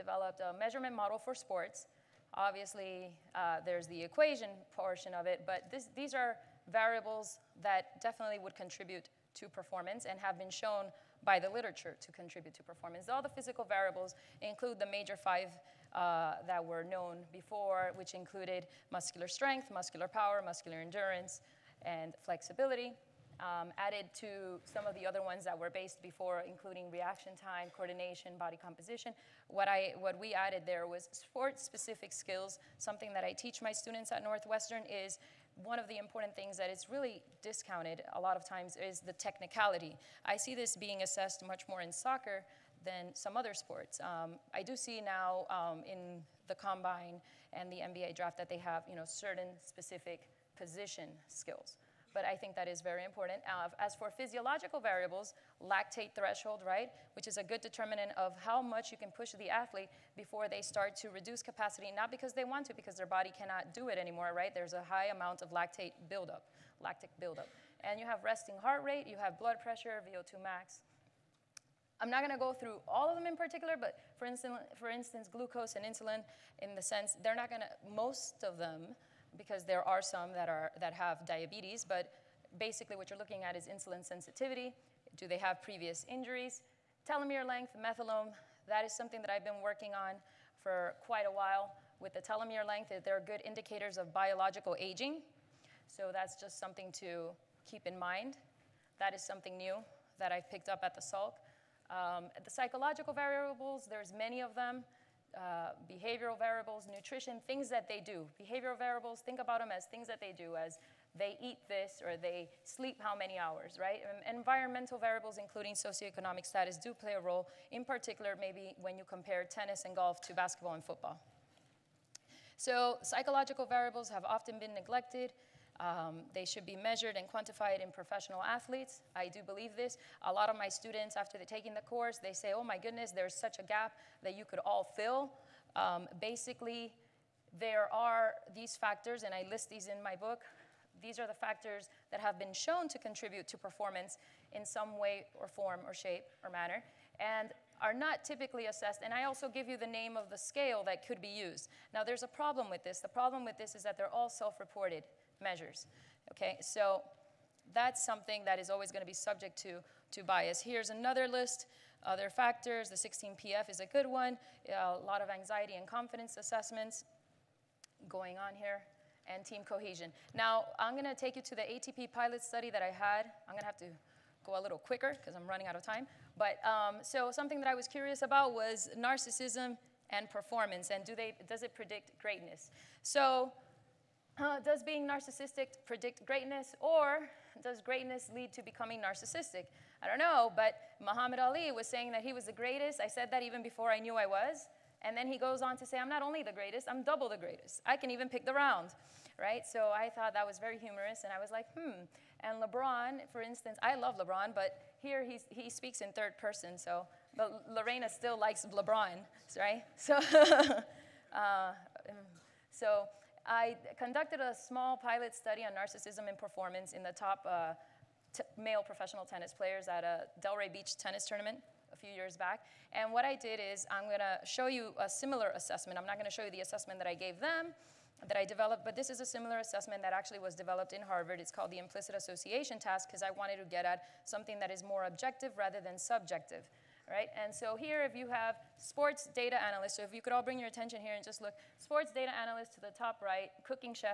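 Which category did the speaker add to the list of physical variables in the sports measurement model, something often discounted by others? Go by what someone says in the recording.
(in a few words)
Sport-specific skills.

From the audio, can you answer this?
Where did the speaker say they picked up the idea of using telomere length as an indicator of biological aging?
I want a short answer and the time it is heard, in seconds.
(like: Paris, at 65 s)
The Salk, at 100 s.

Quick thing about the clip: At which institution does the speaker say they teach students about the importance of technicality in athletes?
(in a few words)
Northwestern.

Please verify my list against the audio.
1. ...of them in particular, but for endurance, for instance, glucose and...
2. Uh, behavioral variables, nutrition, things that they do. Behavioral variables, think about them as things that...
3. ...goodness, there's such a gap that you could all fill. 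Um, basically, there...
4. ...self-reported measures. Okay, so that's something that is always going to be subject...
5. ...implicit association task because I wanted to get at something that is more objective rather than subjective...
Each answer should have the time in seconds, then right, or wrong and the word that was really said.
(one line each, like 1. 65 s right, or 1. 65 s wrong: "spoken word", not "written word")
1. 73 s wrong: "instance", not "endurance"
2. 105 s right
3. 132 s right
4. 154 s right
5. 231 s right.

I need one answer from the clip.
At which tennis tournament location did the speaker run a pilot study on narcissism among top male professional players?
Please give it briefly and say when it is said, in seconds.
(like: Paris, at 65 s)
Delray Beach, at 220 s.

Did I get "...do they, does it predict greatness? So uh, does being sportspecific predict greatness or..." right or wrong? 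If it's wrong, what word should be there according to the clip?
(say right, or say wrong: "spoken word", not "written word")
wrong: "narcissistic", not "sportspecific".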